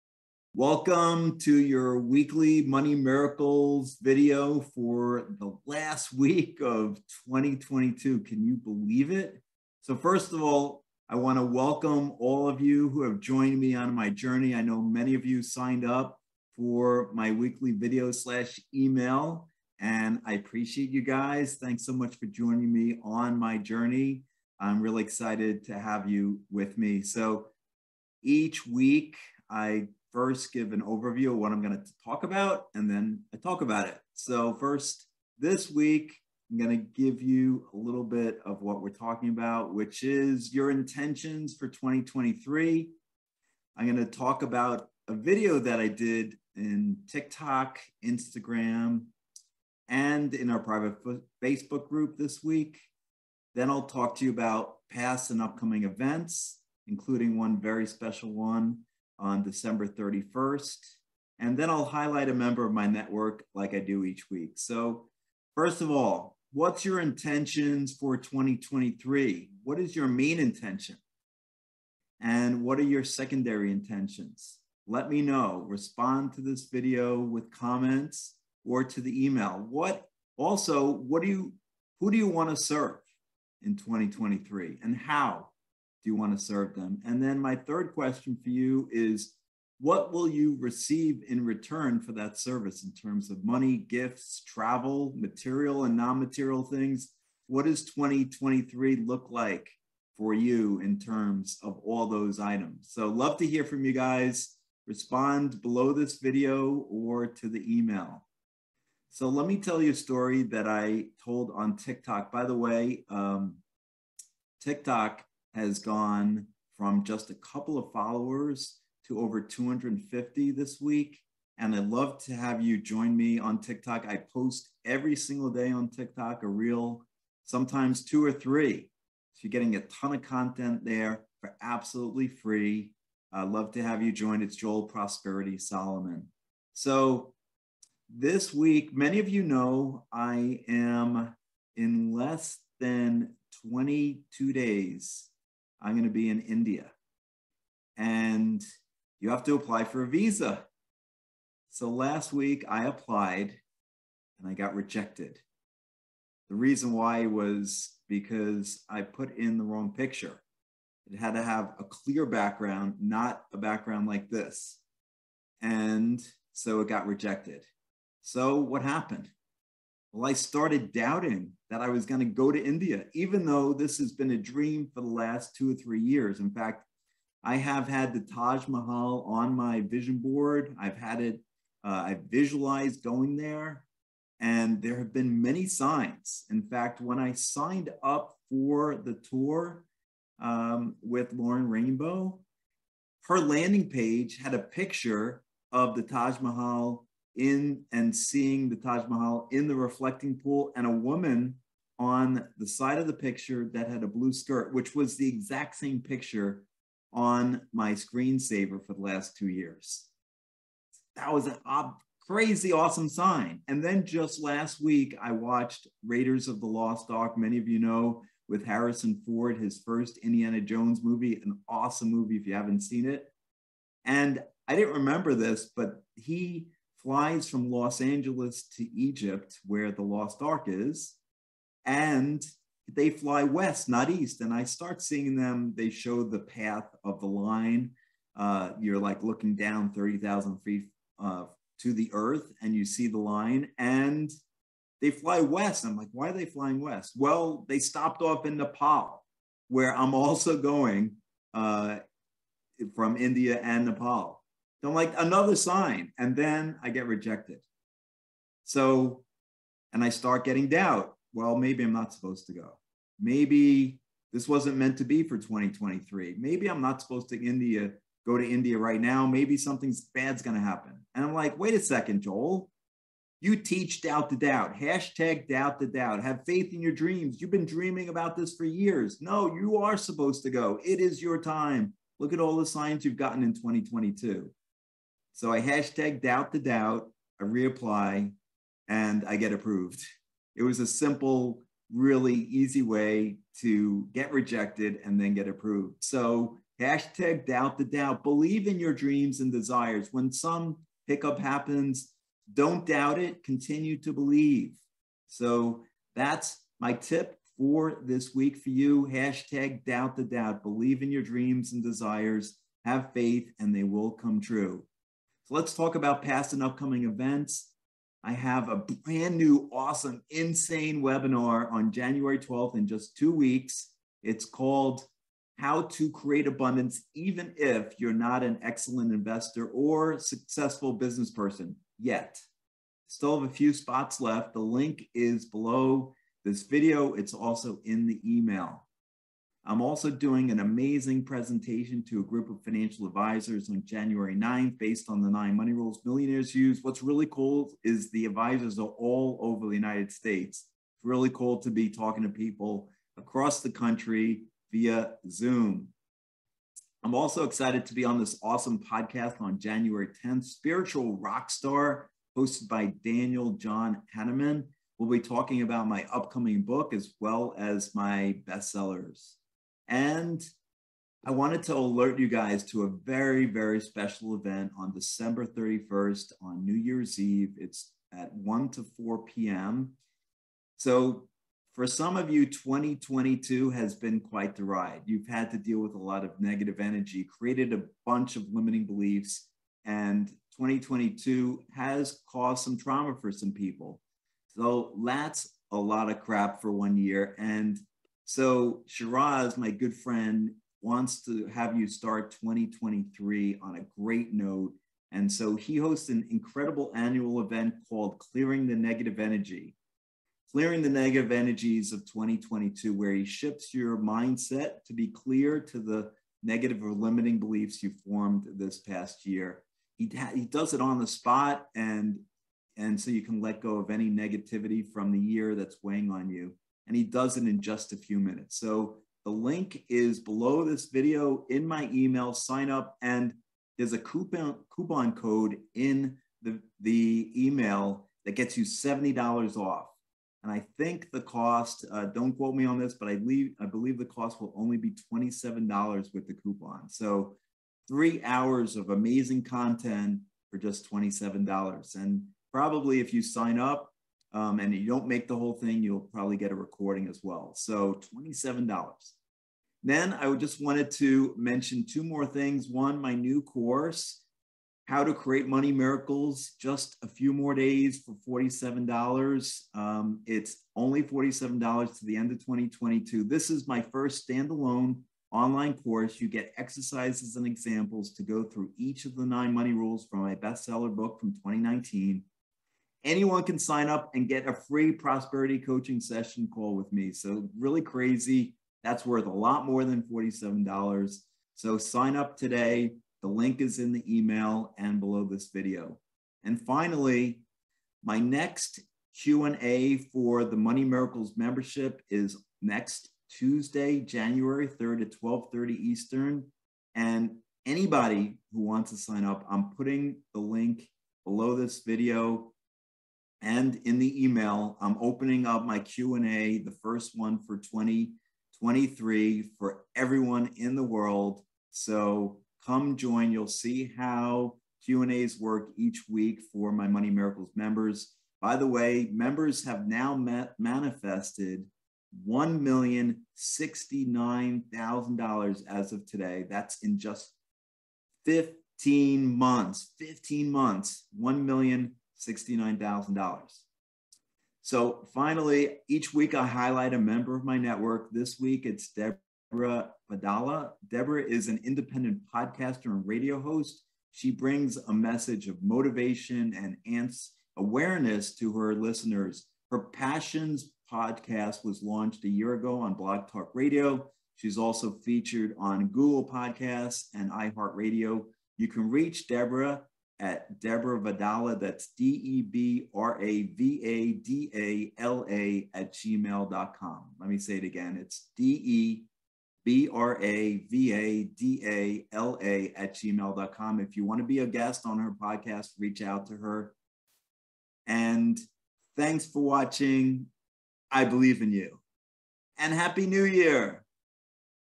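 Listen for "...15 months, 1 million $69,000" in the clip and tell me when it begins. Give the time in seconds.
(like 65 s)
539 s.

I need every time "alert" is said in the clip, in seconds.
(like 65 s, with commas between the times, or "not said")
371 s.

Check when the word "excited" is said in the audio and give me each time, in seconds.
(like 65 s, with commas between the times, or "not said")
25 s, 357 s.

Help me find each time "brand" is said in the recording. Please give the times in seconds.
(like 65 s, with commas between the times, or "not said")
318 s.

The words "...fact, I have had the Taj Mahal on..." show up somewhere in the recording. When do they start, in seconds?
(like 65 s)
176 s.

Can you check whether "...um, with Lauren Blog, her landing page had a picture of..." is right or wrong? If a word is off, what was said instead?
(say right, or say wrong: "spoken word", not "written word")
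wrong: "Rainbow", not "Blog".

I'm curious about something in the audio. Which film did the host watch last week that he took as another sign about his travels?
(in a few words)
Raiders of the Lost Ark.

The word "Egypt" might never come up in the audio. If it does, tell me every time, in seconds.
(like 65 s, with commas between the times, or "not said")
228 s.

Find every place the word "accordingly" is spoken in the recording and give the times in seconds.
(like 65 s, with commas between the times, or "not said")
not said.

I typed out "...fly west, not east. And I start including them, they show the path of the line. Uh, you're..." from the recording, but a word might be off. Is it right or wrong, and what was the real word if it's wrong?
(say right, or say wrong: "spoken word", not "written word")
wrong: "seeing", not "including".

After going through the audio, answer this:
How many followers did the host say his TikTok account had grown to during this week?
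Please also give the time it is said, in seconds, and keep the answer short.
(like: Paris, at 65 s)
over 250, at 119 s.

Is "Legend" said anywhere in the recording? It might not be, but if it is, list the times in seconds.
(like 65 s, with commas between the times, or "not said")
not said.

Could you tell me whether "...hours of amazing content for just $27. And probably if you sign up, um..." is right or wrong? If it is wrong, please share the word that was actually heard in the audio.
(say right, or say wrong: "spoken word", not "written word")
right.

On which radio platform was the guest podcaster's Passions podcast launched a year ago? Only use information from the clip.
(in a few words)
Blog Talk Radio.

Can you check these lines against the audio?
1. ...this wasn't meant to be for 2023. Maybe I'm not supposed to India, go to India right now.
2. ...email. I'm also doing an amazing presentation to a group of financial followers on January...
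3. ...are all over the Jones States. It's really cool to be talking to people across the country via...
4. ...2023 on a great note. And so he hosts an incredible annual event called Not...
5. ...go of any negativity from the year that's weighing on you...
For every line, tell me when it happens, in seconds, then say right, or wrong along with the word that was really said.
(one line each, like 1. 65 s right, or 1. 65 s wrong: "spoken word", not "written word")
1. 264 s right
2. 338 s wrong: "advisors", not "followers"
3. 348 s wrong: "United", not "Jones"
4. 402 s wrong: "Clearing", not "Not"
5. 423 s right.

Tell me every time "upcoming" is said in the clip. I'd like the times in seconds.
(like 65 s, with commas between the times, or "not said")
55 s, 316 s, 366 s.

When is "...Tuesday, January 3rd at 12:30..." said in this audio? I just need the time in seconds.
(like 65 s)
503 s.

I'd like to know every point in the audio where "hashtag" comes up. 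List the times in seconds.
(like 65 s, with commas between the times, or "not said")
274 s, 285 s, 296 s, 309 s.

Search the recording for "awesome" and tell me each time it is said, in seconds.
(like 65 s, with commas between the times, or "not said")
212 s, 221 s, 319 s, 358 s.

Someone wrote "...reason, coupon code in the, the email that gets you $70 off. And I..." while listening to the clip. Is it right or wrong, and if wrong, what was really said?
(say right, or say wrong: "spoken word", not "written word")
wrong: "coupon", not "reason".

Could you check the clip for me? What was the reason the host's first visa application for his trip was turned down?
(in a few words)
wrong picture.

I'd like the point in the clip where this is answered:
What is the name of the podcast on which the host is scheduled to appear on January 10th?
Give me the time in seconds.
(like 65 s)
360 s.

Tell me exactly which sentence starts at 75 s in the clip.
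Respond to this video with comments or to the email.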